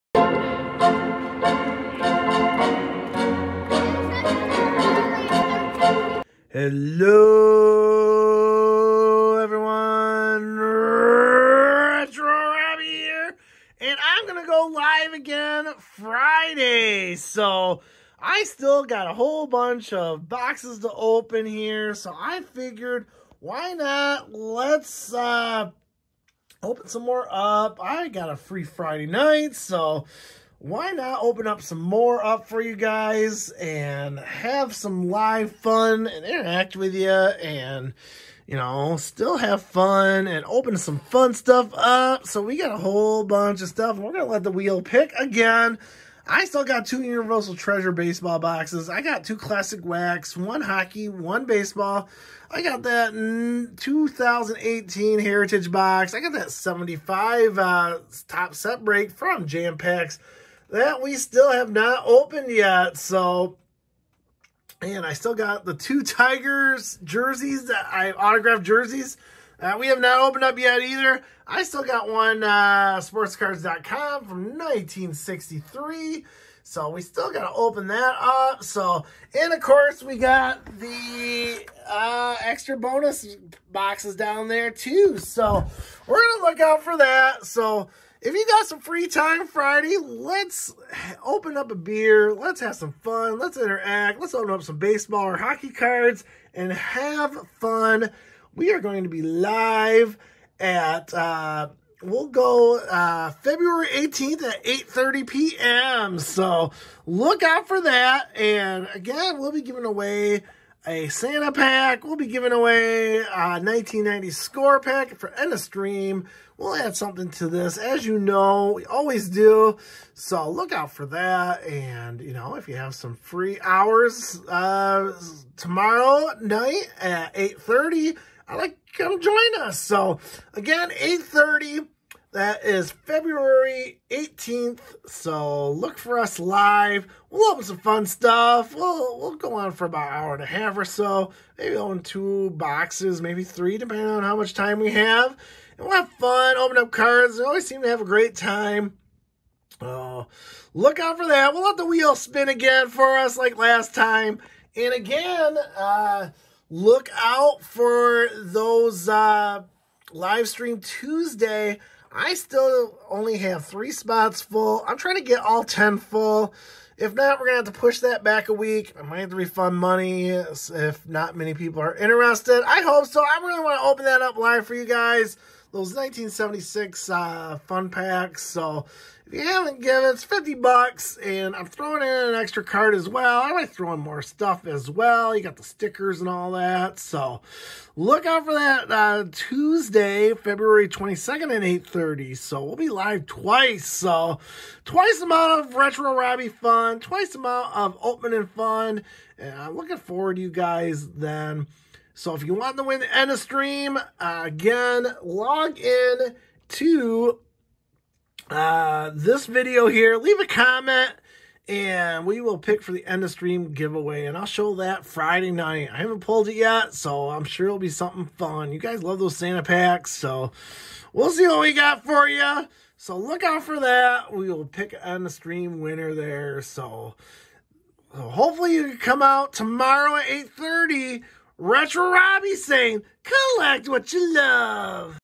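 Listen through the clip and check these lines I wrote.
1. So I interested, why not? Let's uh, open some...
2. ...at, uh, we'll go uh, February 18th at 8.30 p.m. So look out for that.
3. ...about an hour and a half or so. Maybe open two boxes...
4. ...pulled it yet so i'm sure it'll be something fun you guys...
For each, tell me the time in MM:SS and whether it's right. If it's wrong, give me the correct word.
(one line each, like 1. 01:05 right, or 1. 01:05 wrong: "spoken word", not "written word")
1. 00:21 wrong: "figured", not "interested"
2. 01:40 right
3. 02:19 right
4. 03:36 right.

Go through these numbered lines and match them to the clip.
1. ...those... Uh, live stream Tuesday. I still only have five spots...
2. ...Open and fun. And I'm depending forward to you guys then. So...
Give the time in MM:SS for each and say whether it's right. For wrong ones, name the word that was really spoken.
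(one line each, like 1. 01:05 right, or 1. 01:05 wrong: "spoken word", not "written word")
1. 02:38 wrong: "three", not "five"
2. 03:18 wrong: "looking", not "depending".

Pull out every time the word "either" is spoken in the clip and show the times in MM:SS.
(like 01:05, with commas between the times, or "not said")
01:10.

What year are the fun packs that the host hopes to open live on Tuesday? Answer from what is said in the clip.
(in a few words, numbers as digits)
1976.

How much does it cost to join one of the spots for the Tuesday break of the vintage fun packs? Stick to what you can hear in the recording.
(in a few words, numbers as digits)
$50.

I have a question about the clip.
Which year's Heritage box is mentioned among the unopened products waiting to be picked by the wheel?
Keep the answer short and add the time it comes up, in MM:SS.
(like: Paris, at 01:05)
2018, at 00:53.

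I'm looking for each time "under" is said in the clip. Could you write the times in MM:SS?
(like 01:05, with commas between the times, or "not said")
not said.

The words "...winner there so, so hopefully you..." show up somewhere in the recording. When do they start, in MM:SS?
03:45.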